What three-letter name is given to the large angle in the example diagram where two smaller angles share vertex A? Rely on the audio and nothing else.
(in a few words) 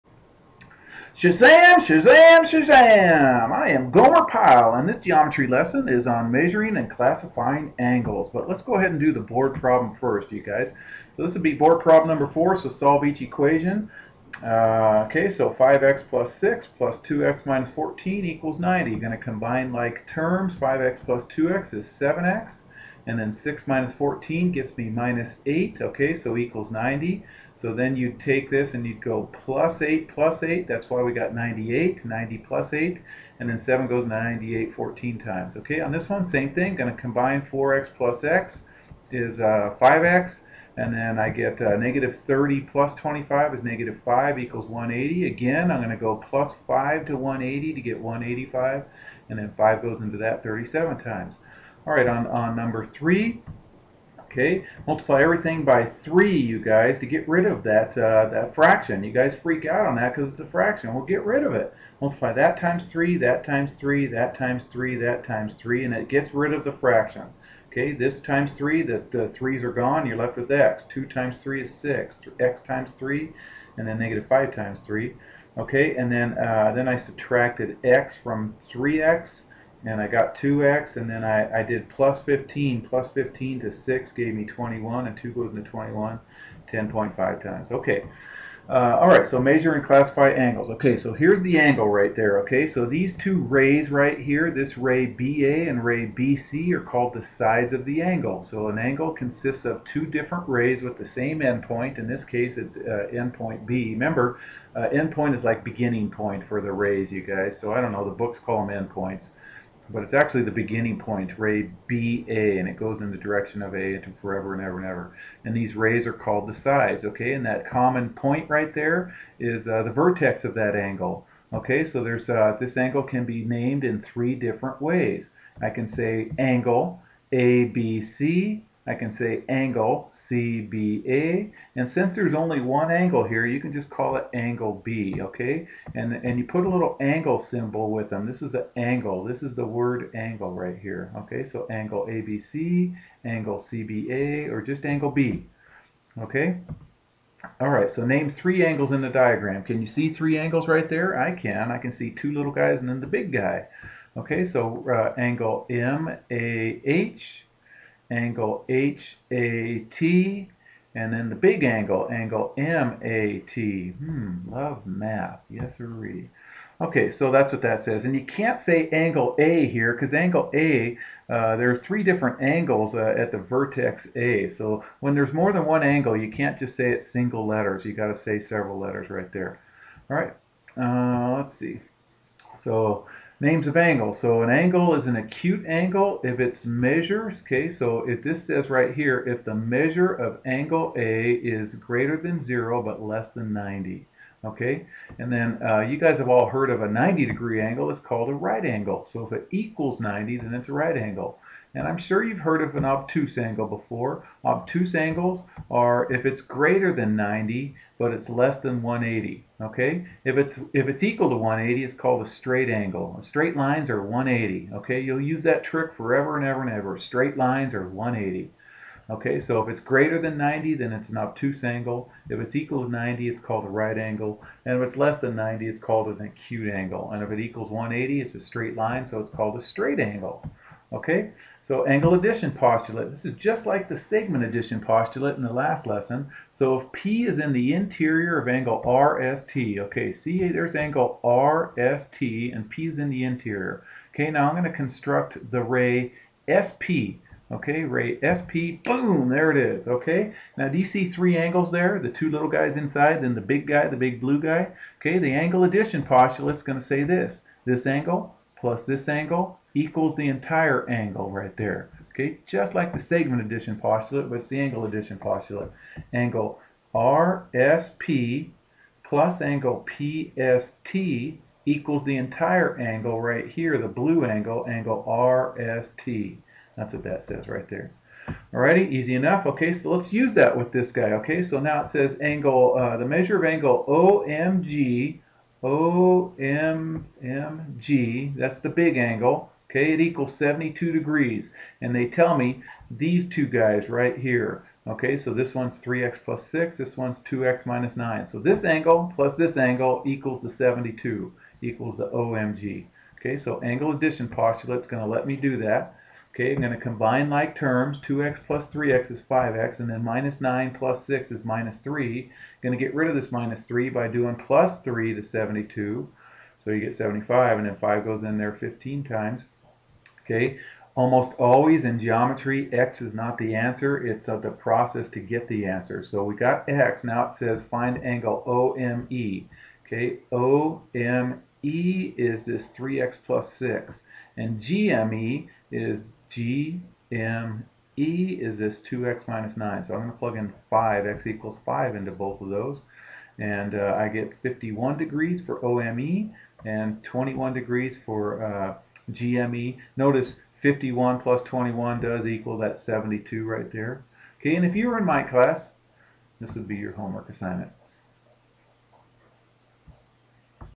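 MAT.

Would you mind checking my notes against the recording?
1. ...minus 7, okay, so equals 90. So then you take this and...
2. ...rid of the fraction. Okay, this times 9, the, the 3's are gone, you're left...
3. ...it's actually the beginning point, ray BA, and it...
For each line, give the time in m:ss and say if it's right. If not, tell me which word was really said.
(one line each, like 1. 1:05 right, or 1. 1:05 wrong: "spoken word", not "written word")
1. 0:24 wrong: "8", not "7"
2. 1:06 wrong: "3", not "9"
3. 1:50 right.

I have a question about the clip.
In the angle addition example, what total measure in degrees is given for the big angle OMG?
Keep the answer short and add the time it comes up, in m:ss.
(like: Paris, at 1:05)
72 degrees, at 4:50.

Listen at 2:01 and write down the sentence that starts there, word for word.
So there's uh, this angle can be named in three different ways.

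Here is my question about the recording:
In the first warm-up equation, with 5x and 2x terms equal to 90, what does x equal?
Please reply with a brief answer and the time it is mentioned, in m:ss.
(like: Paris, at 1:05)
14, at 0:34.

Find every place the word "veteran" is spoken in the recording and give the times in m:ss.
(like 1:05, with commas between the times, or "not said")
not said.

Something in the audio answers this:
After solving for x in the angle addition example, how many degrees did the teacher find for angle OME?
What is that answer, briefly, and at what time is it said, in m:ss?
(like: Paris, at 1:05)
51 degrees, at 5:44.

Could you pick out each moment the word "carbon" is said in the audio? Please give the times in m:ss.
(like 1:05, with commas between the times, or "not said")
not said.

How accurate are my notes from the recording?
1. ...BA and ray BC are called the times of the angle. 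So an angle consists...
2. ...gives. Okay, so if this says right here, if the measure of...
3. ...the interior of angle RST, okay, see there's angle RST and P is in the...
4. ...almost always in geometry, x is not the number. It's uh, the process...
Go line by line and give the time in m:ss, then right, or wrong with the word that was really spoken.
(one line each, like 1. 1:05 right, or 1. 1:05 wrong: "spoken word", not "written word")
1. 1:35 wrong: "sides", not "times"
2. 3:06 wrong: "measures", not "gives"
3. 3:57 right
4. 5:20 wrong: "answer", not "number".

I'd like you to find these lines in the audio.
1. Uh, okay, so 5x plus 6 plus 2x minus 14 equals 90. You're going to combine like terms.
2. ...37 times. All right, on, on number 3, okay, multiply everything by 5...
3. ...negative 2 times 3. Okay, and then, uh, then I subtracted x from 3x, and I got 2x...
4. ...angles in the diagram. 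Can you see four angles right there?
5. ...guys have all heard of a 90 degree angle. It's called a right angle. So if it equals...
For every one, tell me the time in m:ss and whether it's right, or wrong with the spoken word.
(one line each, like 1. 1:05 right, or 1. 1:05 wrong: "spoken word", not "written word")
1. 0:14 right
2. 0:50 wrong: "3", not "5"
3. 1:13 wrong: "5", not "2"
4. 2:28 wrong: "three", not "four"
5. 3:15 right.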